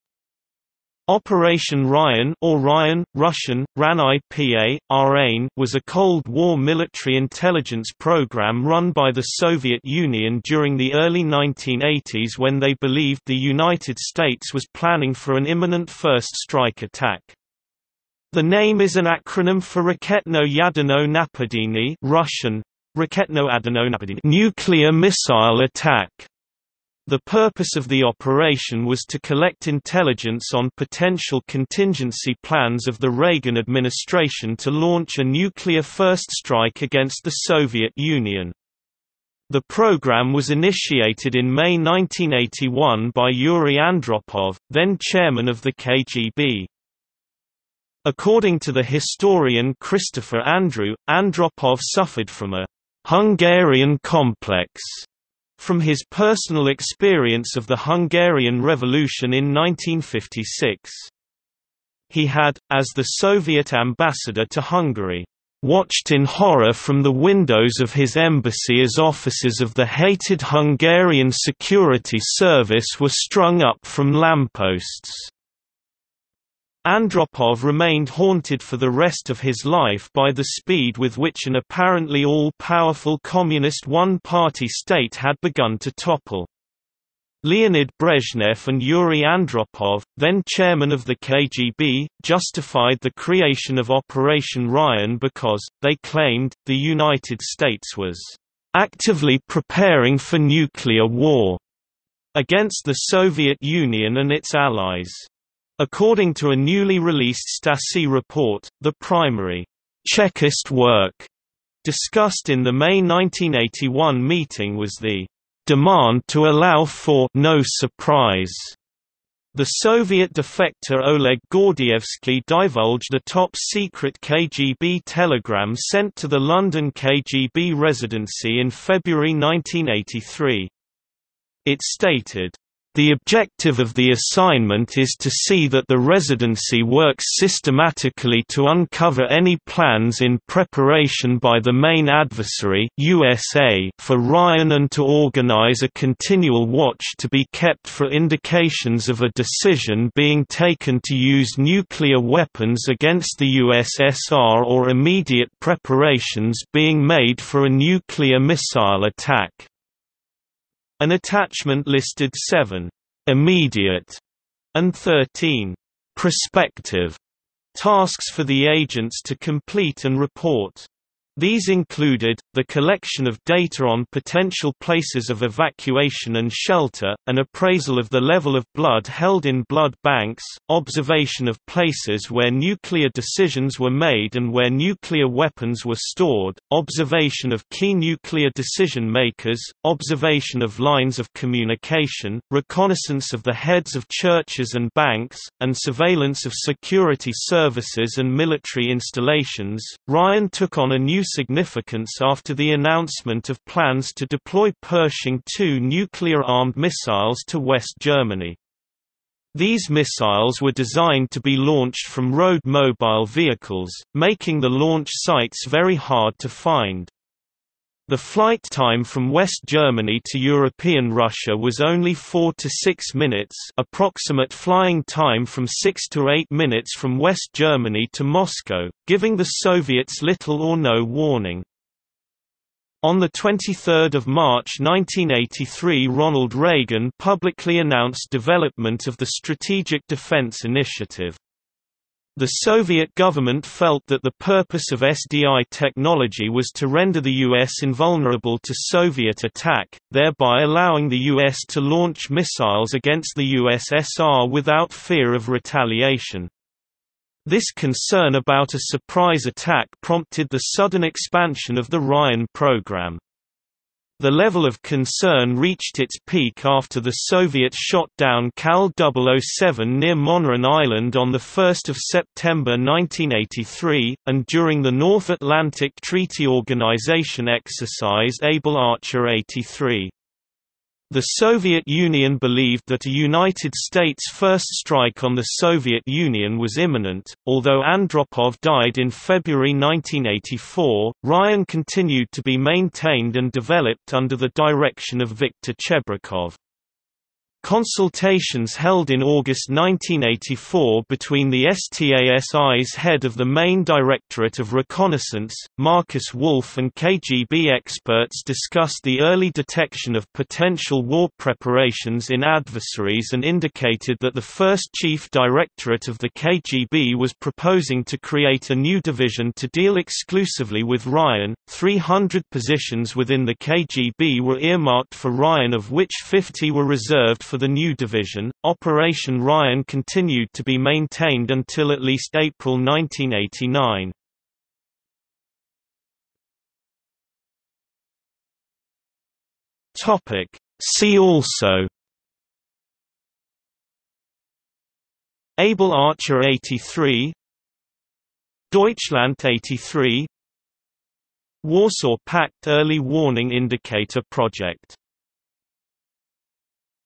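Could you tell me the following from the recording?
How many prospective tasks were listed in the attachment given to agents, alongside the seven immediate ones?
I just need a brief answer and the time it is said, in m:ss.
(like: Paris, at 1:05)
13, at 2:44.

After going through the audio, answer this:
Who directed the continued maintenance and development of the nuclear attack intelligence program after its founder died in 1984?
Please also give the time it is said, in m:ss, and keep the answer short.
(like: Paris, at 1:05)
Viktor Chebrikov, at 4:55.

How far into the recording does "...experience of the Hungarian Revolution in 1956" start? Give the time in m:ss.
0:56.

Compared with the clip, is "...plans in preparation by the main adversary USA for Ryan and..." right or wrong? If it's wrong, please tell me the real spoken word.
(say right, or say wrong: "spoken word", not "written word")
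right.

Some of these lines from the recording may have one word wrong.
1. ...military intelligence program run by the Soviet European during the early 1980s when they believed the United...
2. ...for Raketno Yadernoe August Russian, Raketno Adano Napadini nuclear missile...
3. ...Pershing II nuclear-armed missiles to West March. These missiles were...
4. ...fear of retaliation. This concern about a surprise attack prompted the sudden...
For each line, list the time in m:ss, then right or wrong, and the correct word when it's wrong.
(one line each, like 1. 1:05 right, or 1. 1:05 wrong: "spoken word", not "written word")
1. 0:06 wrong: "Union", not "European"
2. 0:19 wrong: "Napadenie", not "August"
3. 3:24 wrong: "Germany", not "March"
4. 4:14 right.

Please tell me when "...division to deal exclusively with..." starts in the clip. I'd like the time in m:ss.
5:18.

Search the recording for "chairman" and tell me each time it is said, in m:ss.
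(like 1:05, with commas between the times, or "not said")
0:45, 1:30.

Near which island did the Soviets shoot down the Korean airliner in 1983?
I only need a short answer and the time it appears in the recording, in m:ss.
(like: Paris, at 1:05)
Moneron Island, at 4:30.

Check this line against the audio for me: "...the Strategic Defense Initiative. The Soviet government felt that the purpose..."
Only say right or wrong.
right.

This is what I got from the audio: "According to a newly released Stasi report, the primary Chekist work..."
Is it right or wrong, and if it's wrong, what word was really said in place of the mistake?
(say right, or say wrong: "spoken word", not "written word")
right.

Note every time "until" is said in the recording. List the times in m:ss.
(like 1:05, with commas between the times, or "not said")
5:31.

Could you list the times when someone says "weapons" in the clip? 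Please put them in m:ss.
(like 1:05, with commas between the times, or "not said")
2:32, 3:05.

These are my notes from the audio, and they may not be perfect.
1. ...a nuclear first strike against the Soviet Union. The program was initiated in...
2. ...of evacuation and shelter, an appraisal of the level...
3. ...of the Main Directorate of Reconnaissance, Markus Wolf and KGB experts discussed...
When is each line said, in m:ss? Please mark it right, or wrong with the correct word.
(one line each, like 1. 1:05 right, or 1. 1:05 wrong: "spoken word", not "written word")
1. 0:35 right
2. 2:55 right
3. 5:03 right.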